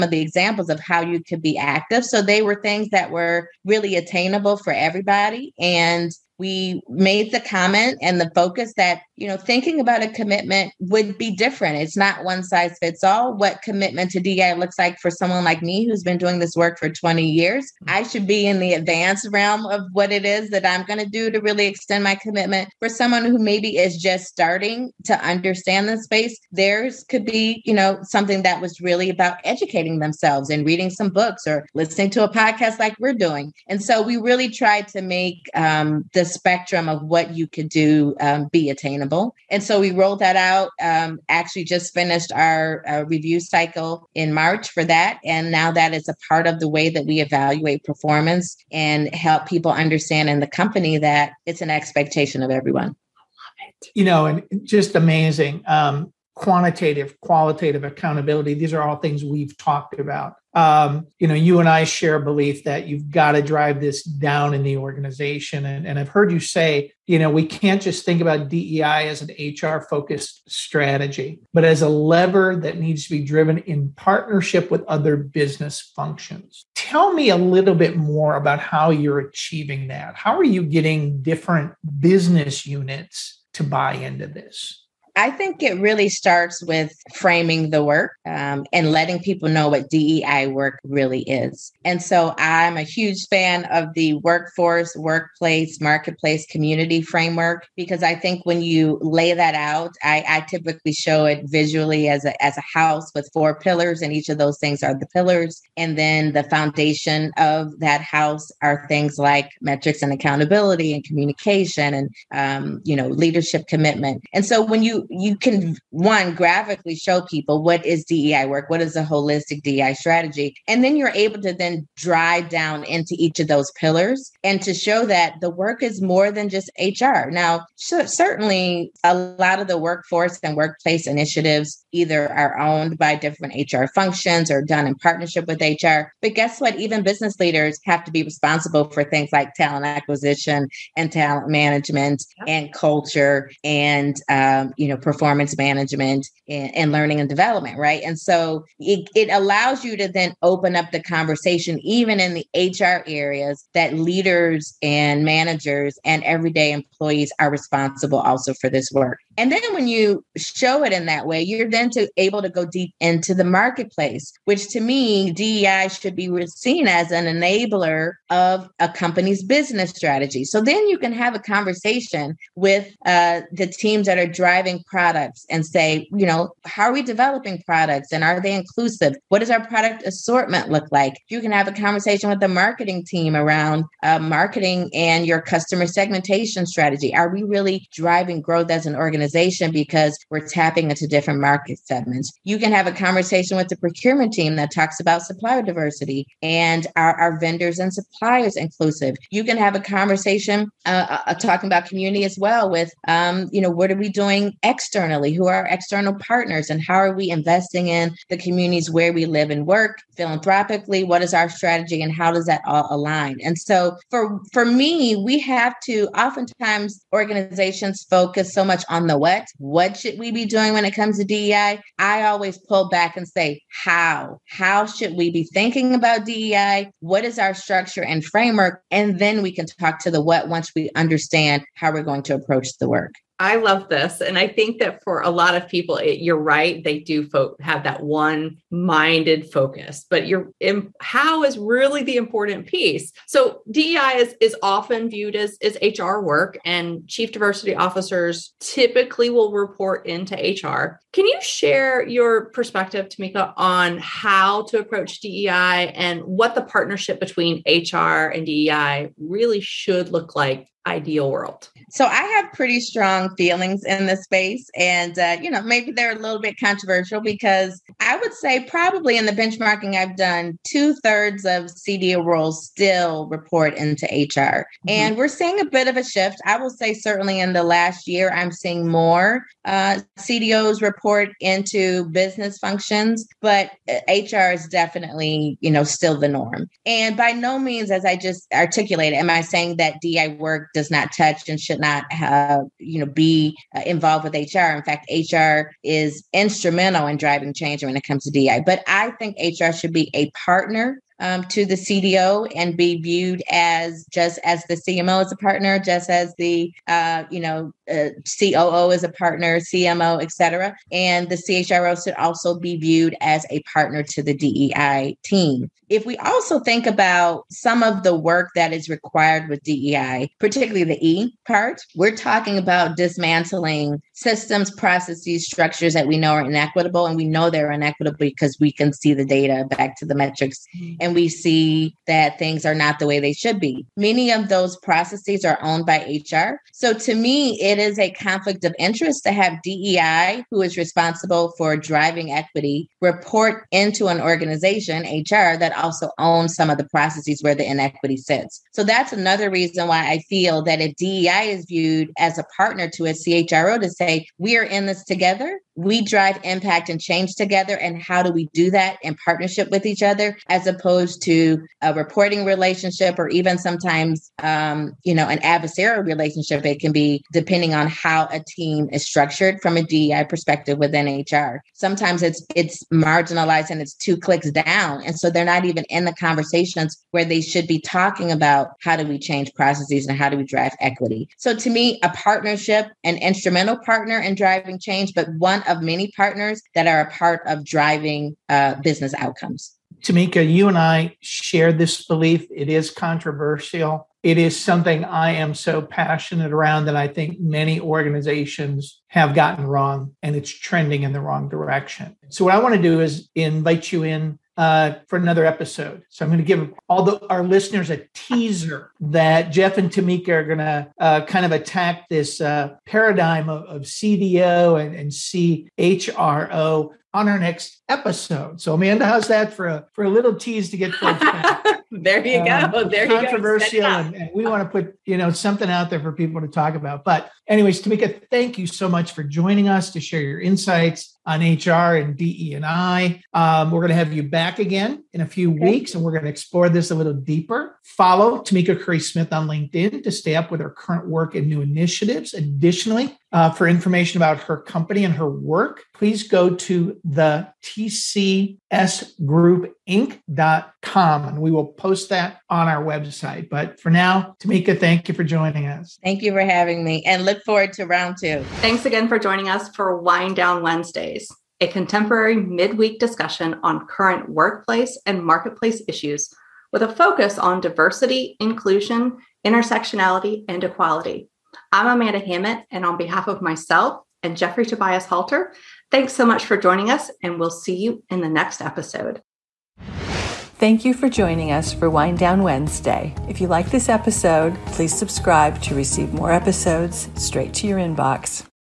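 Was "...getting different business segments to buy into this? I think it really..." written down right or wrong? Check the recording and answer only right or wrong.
wrong.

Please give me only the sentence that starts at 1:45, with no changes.
And then the foundation of that house are things like metrics and accountability and communication and um, you know leadership commitment.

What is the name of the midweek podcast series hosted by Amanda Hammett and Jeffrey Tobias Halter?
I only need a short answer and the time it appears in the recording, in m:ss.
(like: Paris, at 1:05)
Wind Down Wednesdays, at 7:39.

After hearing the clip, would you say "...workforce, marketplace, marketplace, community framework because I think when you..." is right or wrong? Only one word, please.
wrong.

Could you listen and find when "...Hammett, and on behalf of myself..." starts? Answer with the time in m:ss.
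7:52.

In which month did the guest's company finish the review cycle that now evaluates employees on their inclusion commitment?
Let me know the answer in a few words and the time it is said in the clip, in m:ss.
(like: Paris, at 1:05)
March, at 0:44.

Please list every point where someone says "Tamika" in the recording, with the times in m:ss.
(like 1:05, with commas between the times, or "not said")
4:13, 6:30, 6:49, 7:07, 7:18, 7:34.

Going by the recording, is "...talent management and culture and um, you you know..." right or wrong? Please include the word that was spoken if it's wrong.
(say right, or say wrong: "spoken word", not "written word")
right.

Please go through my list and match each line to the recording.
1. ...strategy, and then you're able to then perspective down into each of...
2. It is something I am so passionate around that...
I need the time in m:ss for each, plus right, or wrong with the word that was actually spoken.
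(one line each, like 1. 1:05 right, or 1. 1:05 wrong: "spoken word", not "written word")
1. 1:59 wrong: "drive", not "perspective"
2. 6:34 right.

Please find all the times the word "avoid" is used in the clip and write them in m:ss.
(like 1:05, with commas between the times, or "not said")
not said.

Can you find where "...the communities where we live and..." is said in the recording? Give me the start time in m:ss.
3:28.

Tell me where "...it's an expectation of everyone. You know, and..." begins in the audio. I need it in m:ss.
0:51.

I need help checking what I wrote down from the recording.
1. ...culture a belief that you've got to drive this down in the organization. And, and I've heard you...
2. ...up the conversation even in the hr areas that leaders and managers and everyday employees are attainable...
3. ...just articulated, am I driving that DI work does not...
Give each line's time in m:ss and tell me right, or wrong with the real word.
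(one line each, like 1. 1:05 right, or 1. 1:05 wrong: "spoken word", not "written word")
1. 1:01 wrong: "share", not "culture"
2. 2:30 wrong: "responsible", not "attainable"
3. 4:48 wrong: "saying", not "driving".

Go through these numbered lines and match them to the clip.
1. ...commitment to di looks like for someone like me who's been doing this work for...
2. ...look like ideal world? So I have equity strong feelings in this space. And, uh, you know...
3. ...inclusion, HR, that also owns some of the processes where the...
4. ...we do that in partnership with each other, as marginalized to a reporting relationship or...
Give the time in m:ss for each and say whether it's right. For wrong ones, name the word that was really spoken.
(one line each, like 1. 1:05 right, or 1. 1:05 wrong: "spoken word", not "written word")
1. 0:13 right
2. 4:20 wrong: "pretty", not "equity"
3. 5:44 wrong: "organization", not "inclusion"
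4. 5:58 wrong: "opposed", not "marginalized".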